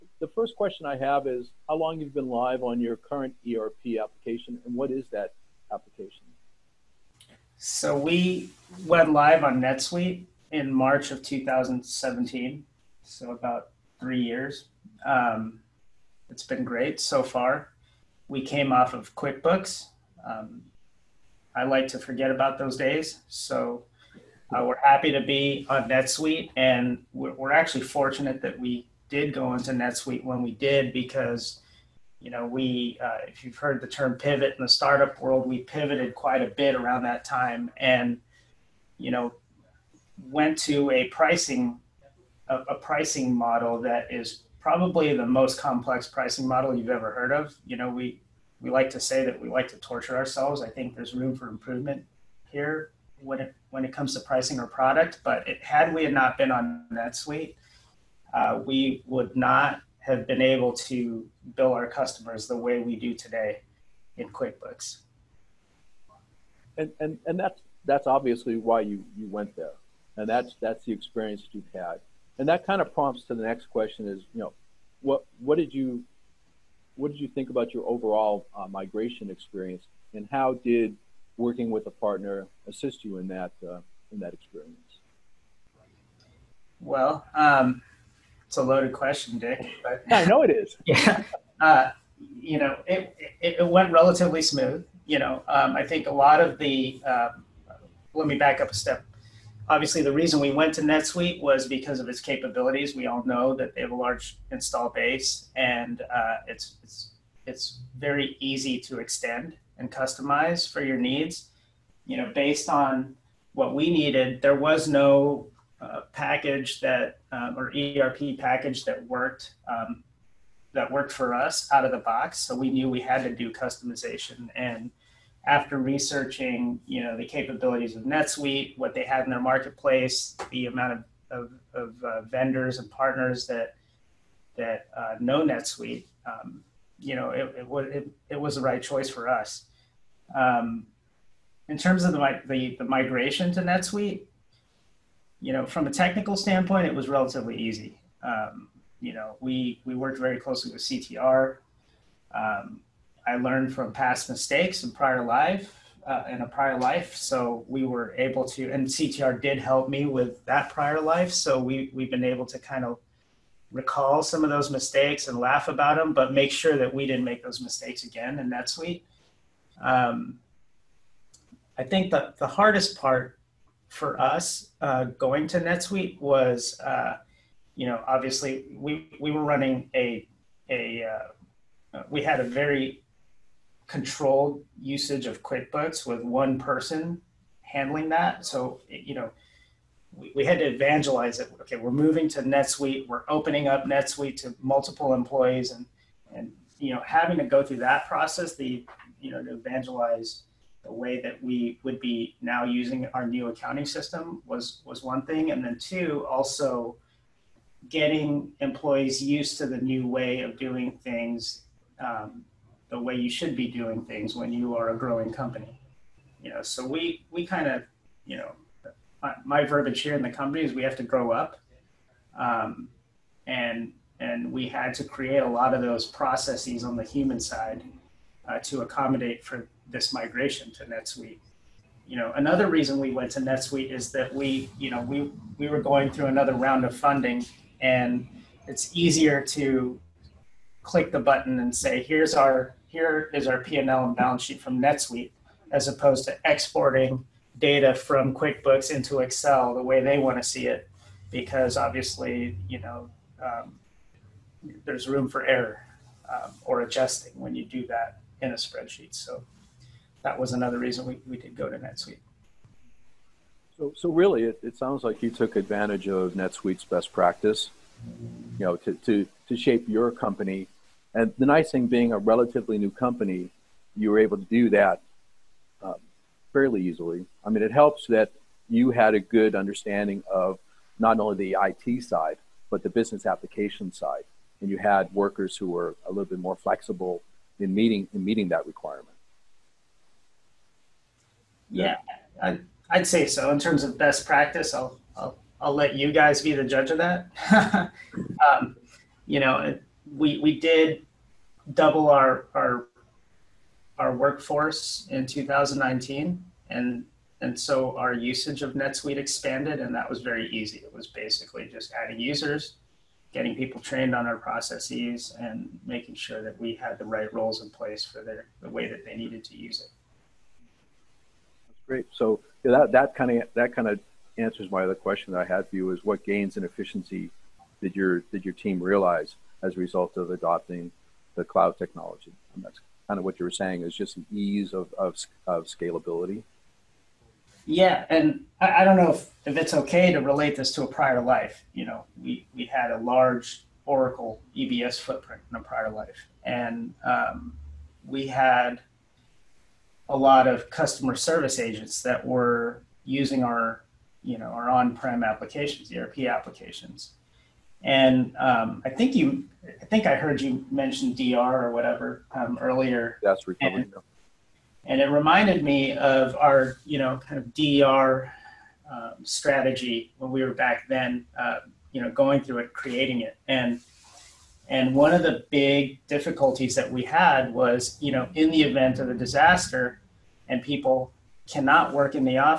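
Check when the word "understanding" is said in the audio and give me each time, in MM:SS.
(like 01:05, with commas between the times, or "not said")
04:39.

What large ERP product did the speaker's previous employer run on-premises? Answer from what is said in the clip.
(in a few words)
Oracle EBS.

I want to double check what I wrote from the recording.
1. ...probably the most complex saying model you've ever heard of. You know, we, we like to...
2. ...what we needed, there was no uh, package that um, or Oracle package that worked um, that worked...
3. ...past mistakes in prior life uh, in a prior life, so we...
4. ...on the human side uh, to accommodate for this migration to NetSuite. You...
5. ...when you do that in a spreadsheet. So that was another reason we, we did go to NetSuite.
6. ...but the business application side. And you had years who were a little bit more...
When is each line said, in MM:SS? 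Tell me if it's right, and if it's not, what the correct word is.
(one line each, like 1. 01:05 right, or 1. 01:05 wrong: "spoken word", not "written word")
1. 00:44 wrong: "pricing", not "saying"
2. 01:53 wrong: "ERP", not "Oracle"
3. 02:33 right
4. 03:46 right
5. 04:17 right
6. 04:42 wrong: "workers", not "years".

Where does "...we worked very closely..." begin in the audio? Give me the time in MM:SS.
02:29.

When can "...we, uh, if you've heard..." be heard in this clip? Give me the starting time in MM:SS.
00:32.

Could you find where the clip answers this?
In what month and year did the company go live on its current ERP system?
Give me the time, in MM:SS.
00:10.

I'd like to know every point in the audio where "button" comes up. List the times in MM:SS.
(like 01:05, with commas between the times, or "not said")
04:01.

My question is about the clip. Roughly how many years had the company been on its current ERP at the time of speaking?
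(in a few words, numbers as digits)
3 years.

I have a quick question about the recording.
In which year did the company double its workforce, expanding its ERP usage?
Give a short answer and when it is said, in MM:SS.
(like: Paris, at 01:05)
2019, at 05:05.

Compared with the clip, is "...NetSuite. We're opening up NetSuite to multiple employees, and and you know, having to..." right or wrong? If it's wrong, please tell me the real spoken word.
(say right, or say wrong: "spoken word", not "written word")
right.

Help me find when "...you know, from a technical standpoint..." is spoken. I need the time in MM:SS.
02:25.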